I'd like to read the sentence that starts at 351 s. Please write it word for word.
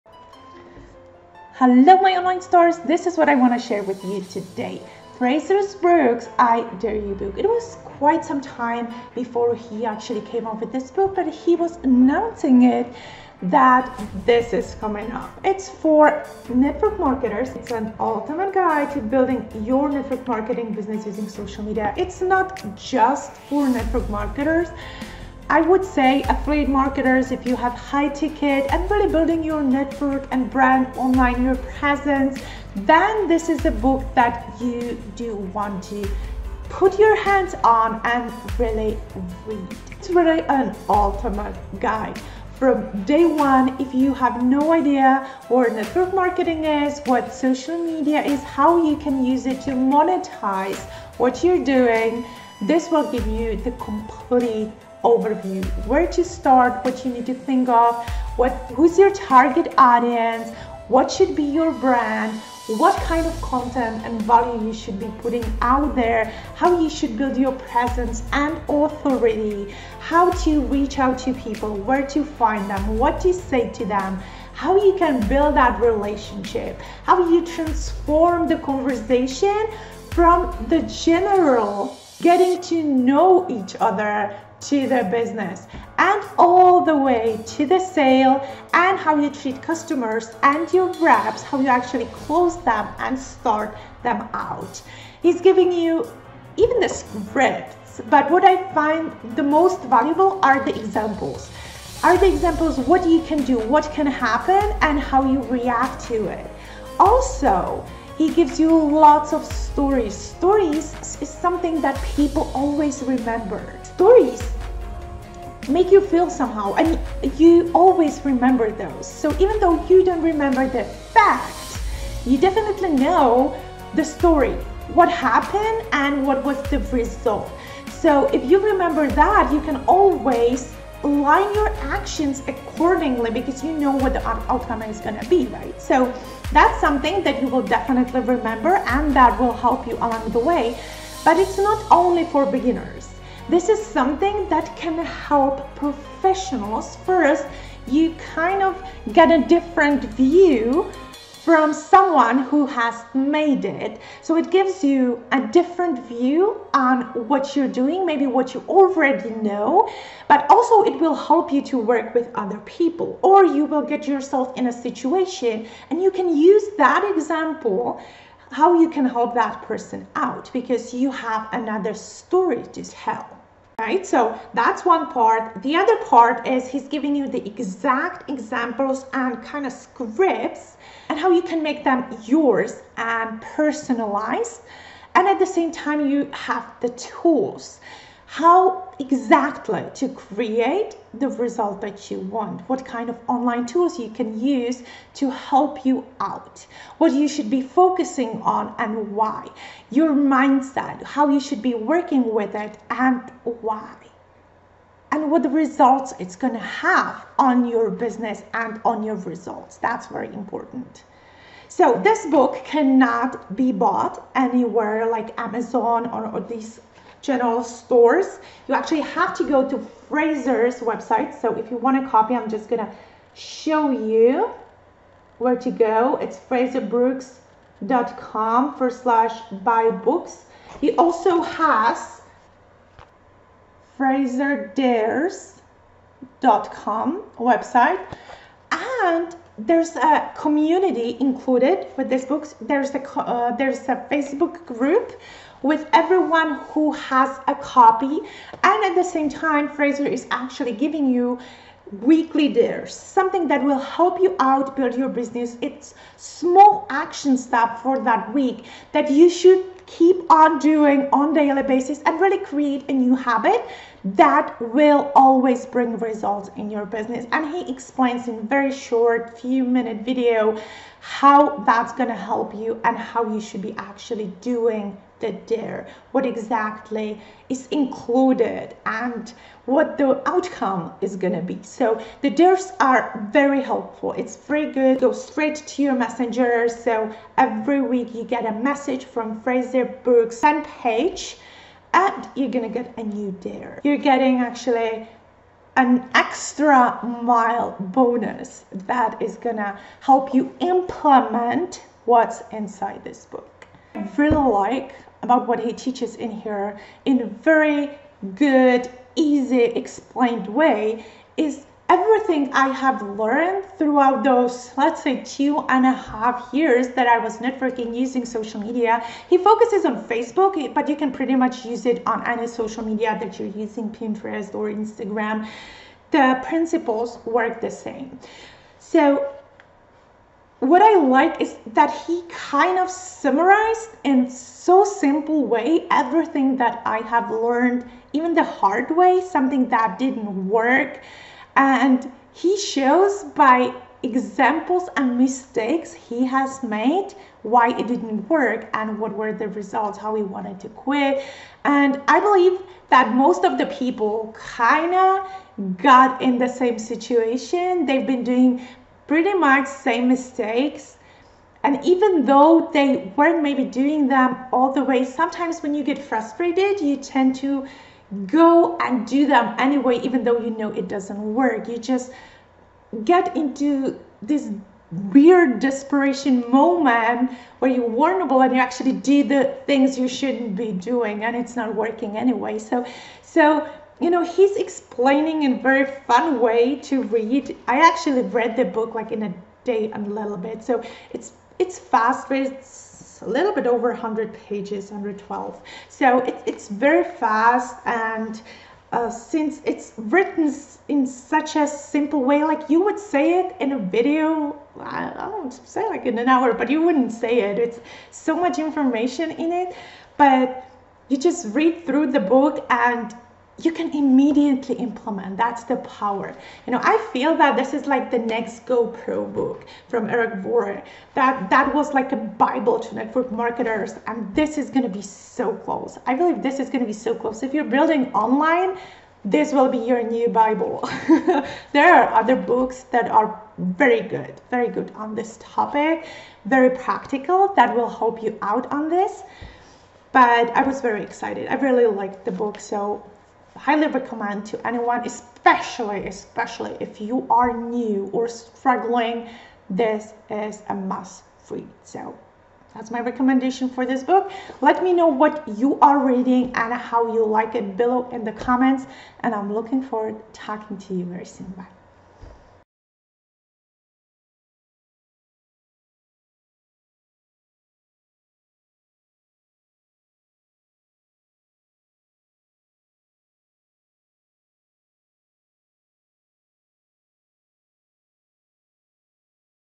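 And I believe that most of the people kind of got in the same situation.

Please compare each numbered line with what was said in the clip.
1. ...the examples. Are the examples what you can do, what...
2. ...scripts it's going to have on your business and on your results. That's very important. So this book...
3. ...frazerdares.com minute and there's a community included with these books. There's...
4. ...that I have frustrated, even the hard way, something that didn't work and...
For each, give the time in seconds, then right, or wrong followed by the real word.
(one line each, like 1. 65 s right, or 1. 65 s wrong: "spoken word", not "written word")
1. 100 s right
2. 205 s wrong: "results", not "scripts"
3. 233 s wrong: "website", not "minute"
4. 336 s wrong: "learned", not "frustrated".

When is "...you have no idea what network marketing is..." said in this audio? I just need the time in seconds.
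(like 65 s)
43 s.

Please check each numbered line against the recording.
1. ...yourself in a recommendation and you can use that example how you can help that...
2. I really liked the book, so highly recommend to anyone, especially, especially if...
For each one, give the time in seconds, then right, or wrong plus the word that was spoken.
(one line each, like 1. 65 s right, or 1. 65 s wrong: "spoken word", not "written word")
1. 164 s wrong: "situation", not "recommendation"
2. 441 s right.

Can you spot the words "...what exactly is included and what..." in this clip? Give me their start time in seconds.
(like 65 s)
276 s.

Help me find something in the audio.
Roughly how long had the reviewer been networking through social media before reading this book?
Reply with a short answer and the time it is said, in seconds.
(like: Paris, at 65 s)
two and a half years, at 315 s.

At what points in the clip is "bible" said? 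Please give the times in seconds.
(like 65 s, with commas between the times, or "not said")
422 s, 430 s.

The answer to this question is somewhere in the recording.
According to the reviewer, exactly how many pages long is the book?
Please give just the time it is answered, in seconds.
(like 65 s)
394 s.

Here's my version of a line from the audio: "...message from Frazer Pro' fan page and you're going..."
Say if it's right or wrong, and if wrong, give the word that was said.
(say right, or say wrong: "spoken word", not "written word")
wrong: "Brookes", not "Pro".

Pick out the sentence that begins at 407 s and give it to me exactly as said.
It's so much information in it, but you just read through the book and you can immediately implement.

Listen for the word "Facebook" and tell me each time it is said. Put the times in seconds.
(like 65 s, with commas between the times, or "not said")
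244 s, 320 s.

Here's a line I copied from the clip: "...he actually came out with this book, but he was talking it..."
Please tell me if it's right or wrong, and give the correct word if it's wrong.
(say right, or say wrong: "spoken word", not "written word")
wrong: "announcing", not "talking".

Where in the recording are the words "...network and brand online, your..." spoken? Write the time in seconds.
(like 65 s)
29 s.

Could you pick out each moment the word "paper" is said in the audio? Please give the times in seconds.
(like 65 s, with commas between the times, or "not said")
not said.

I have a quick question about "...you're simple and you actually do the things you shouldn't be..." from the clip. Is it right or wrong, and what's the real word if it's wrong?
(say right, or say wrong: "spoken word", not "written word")
wrong: "vulnerable", not "simple".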